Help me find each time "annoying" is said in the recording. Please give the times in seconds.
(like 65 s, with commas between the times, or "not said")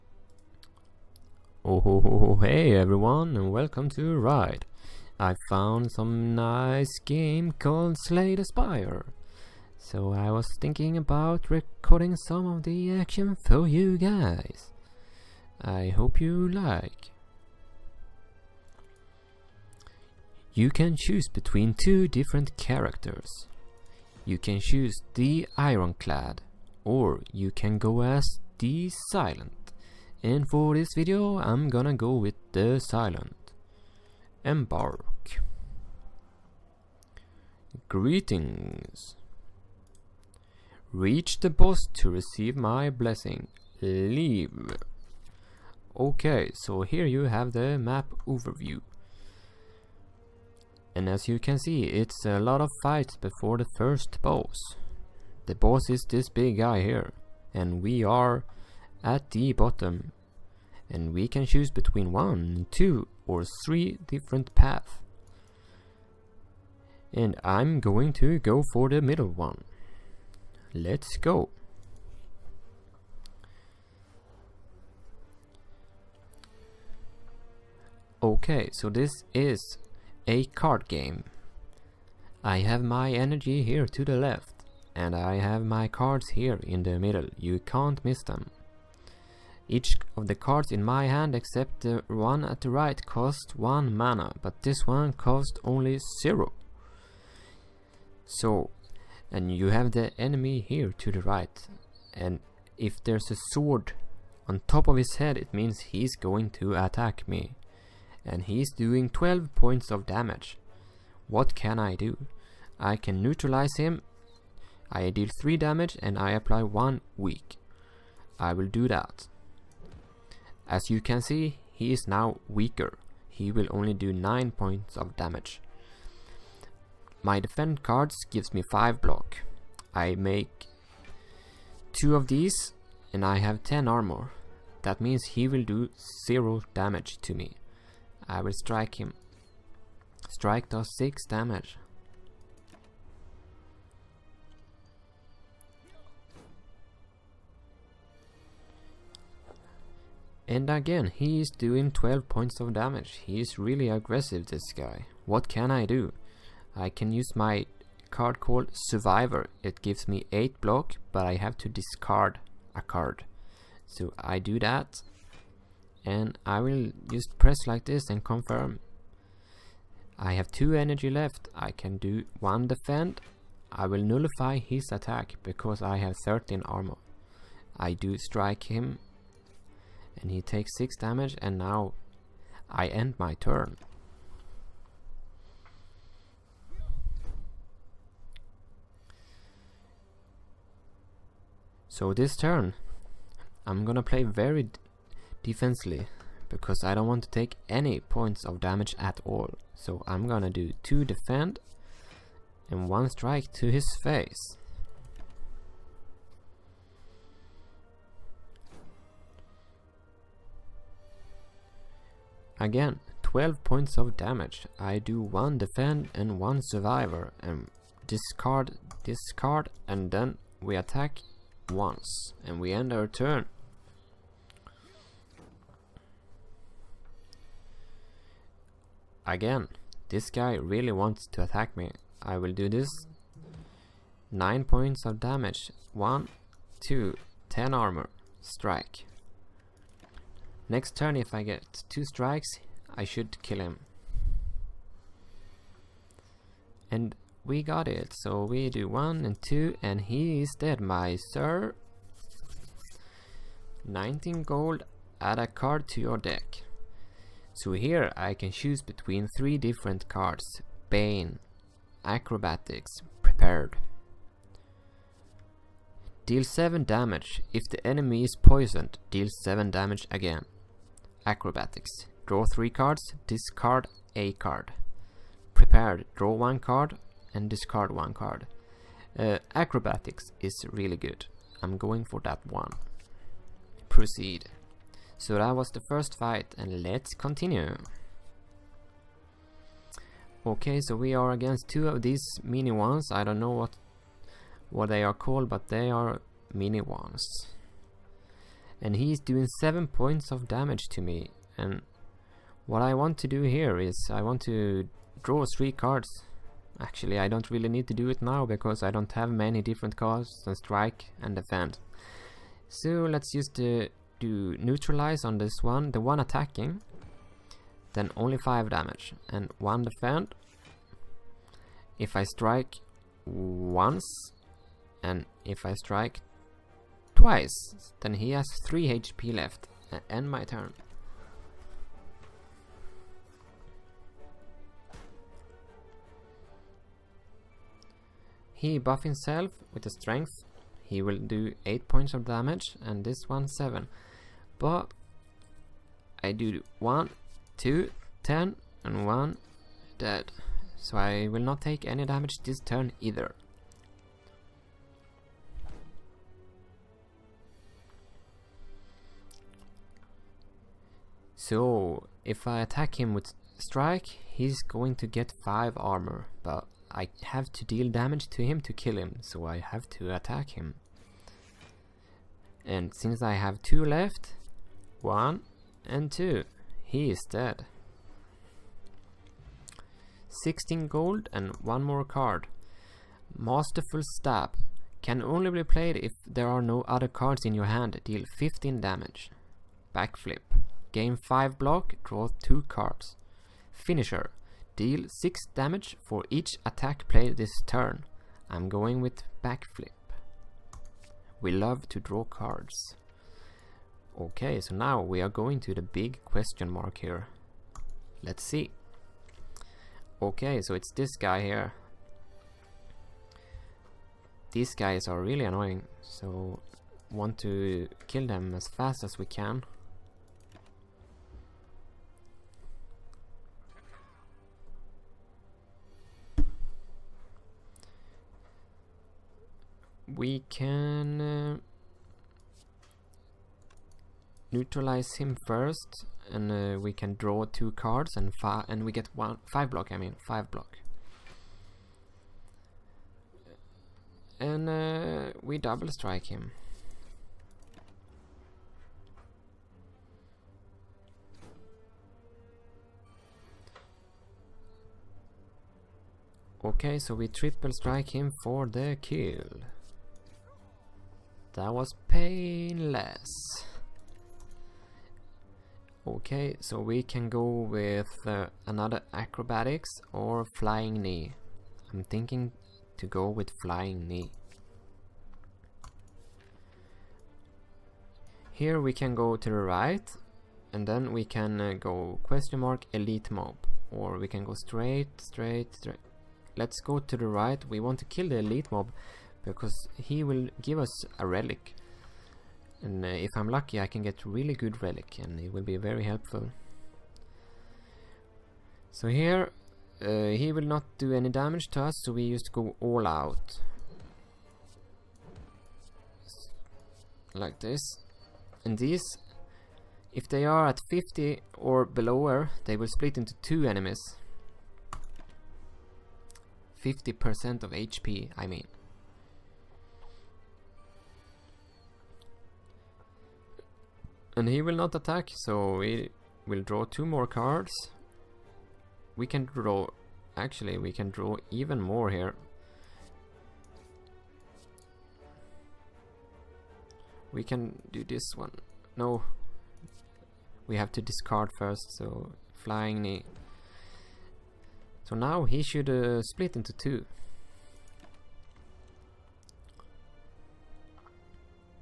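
415 s.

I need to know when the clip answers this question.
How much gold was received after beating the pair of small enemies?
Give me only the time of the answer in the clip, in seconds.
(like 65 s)
380 s.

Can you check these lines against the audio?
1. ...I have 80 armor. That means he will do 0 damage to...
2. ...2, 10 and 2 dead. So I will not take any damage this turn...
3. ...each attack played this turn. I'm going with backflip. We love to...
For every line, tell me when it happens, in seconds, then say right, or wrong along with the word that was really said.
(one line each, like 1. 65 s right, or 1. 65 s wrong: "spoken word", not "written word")
1. 133 s wrong: "10", not "80"
2. 347 s wrong: "1", not "2"
3. 396 s right.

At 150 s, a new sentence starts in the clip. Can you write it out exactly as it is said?
And again, he is doing 12 points of damage.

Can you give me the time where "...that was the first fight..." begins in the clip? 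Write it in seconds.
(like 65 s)
285 s.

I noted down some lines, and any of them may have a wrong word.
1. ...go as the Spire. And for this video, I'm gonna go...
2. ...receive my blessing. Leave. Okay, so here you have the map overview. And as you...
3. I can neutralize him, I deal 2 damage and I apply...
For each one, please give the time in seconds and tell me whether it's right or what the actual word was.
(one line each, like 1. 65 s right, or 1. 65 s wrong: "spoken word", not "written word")
1. 27 s wrong: "Silent", not "Spire"
2. 42 s right
3. 112 s wrong: "3", not "2".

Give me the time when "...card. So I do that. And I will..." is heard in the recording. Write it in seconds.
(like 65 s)
162 s.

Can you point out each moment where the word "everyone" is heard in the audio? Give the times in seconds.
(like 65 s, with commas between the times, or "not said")
2 s.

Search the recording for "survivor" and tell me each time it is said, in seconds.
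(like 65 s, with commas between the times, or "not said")
158 s, 216 s.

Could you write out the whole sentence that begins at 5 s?
I found some nice game called Slay the Spire.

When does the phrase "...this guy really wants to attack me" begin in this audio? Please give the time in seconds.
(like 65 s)
230 s.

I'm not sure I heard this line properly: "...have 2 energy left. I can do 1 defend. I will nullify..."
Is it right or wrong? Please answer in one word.
right.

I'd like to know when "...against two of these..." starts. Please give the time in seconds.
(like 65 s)
291 s.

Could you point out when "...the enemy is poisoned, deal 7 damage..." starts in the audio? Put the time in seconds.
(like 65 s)
267 s.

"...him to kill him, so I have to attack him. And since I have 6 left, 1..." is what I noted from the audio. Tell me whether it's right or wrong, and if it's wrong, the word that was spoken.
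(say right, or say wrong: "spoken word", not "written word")
wrong: "2", not "6".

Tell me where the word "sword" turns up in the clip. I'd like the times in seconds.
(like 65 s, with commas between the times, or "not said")
103 s.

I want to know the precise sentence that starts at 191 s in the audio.
So this turn I'm gonna play very defensively because I don't want to take any points of damage at all.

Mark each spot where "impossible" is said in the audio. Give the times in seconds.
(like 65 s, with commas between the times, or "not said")
not said.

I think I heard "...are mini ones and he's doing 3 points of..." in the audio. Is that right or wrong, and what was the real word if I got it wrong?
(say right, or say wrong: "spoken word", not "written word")
wrong: "7", not "3".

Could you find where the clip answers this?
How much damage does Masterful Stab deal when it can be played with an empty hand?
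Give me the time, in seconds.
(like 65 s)
388 s.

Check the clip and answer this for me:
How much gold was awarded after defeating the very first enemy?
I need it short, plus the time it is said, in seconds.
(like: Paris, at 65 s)
19, at 253 s.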